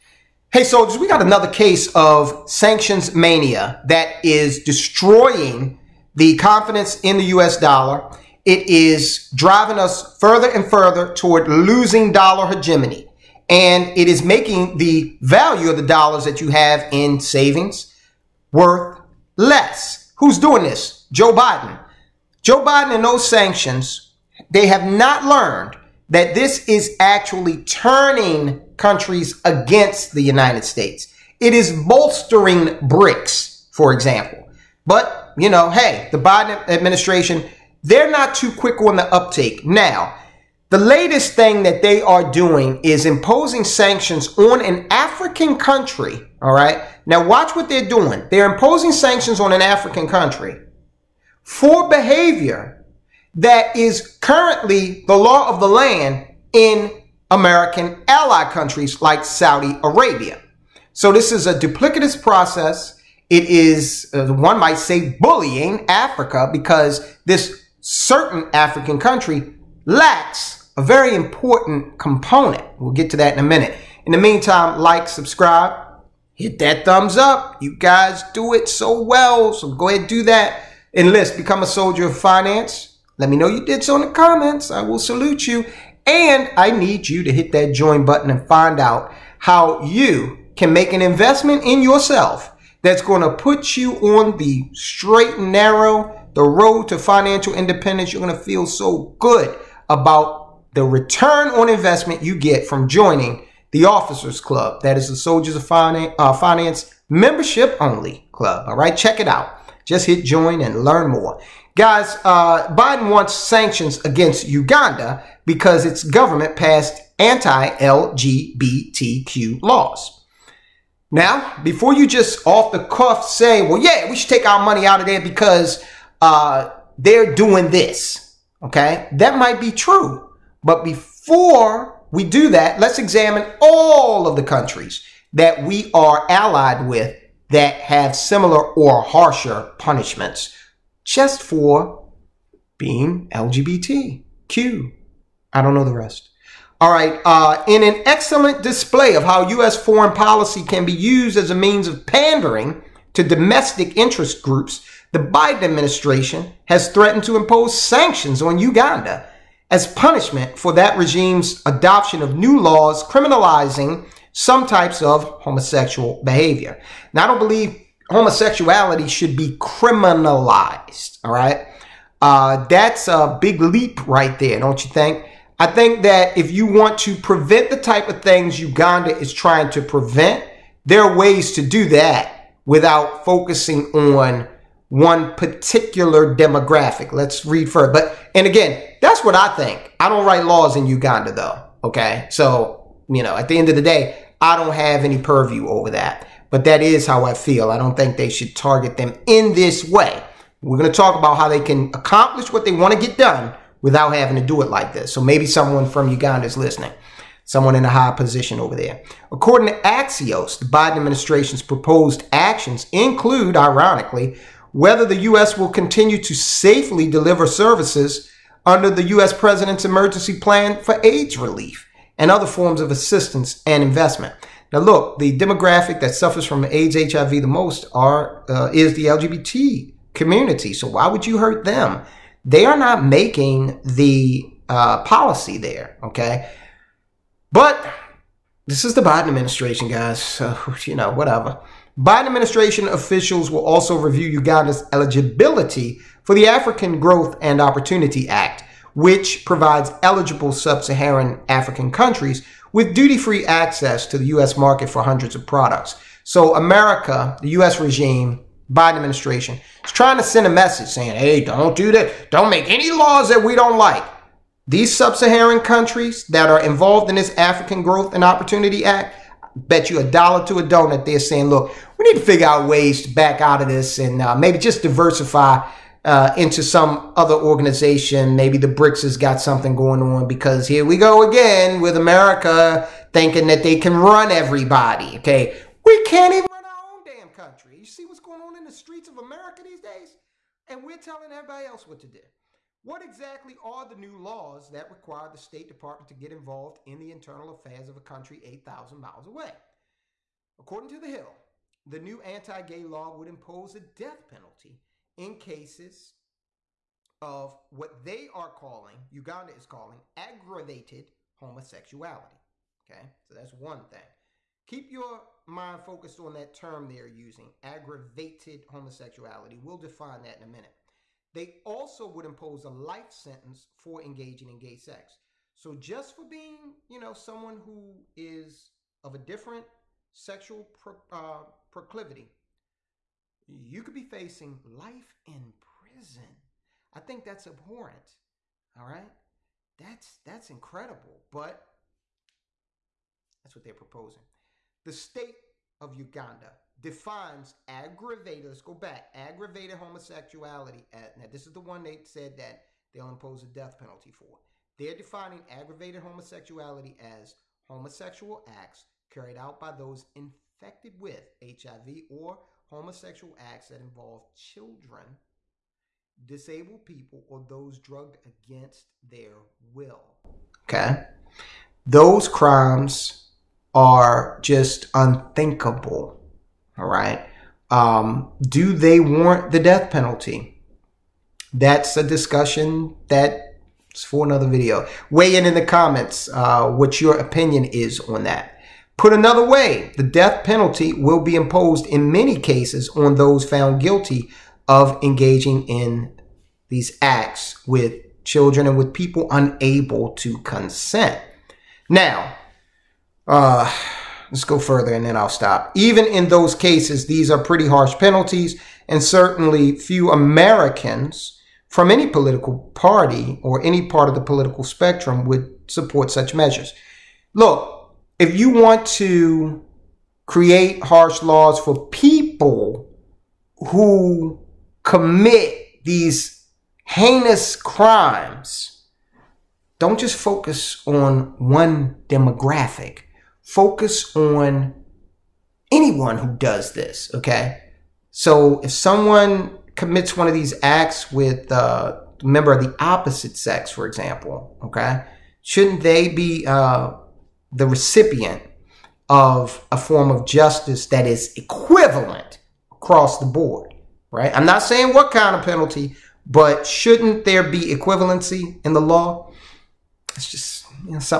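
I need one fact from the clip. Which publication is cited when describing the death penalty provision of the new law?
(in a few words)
The Hill.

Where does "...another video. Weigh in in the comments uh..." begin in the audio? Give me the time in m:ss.
6:24.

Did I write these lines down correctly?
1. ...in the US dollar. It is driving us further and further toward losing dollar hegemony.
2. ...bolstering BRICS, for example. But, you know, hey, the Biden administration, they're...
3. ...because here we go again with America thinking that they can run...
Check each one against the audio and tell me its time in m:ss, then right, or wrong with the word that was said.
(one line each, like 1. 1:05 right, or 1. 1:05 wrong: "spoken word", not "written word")
1. 0:07 right
2. 0:31 right
3. 4:40 right.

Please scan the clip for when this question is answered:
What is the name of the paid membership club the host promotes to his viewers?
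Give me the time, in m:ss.
1:43.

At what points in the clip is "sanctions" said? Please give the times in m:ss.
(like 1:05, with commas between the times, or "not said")
0:02, 0:23, 0:43, 0:48, 1:53, 2:37.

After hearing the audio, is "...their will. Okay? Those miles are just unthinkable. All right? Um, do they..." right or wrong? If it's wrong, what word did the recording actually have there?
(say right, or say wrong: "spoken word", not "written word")
wrong: "crimes", not "miles".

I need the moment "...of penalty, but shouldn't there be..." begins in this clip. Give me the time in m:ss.
7:35.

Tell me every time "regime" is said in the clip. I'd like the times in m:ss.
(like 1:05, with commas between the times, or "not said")
2:40, 4:17.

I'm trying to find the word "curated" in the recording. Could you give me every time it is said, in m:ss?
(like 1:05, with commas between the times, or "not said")
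not said.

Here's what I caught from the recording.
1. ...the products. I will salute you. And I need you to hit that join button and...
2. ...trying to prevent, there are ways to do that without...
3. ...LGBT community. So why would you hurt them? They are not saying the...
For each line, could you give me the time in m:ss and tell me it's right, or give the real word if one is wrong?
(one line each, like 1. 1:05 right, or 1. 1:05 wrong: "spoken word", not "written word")
1. 1:24 wrong: "comments", not "products"
2. 2:59 right
3. 3:49 wrong: "making", not "saying".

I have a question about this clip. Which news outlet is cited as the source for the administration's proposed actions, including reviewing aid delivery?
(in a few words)
Axios.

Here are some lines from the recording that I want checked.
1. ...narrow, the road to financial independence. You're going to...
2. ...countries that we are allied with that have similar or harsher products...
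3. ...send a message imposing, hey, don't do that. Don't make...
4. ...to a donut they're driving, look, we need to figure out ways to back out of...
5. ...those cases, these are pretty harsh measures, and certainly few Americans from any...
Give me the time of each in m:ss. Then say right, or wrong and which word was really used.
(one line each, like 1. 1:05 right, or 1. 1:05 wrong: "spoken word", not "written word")
1. 1:35 right
2. 2:14 wrong: "punishments", not "products"
3. 4:20 wrong: "saying", not "imposing"
4. 4:30 wrong: "saying", not "driving"
5. 6:46 wrong: "penalties", not "measures".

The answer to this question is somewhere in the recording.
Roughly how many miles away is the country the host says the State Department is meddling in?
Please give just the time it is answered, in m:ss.
4:58.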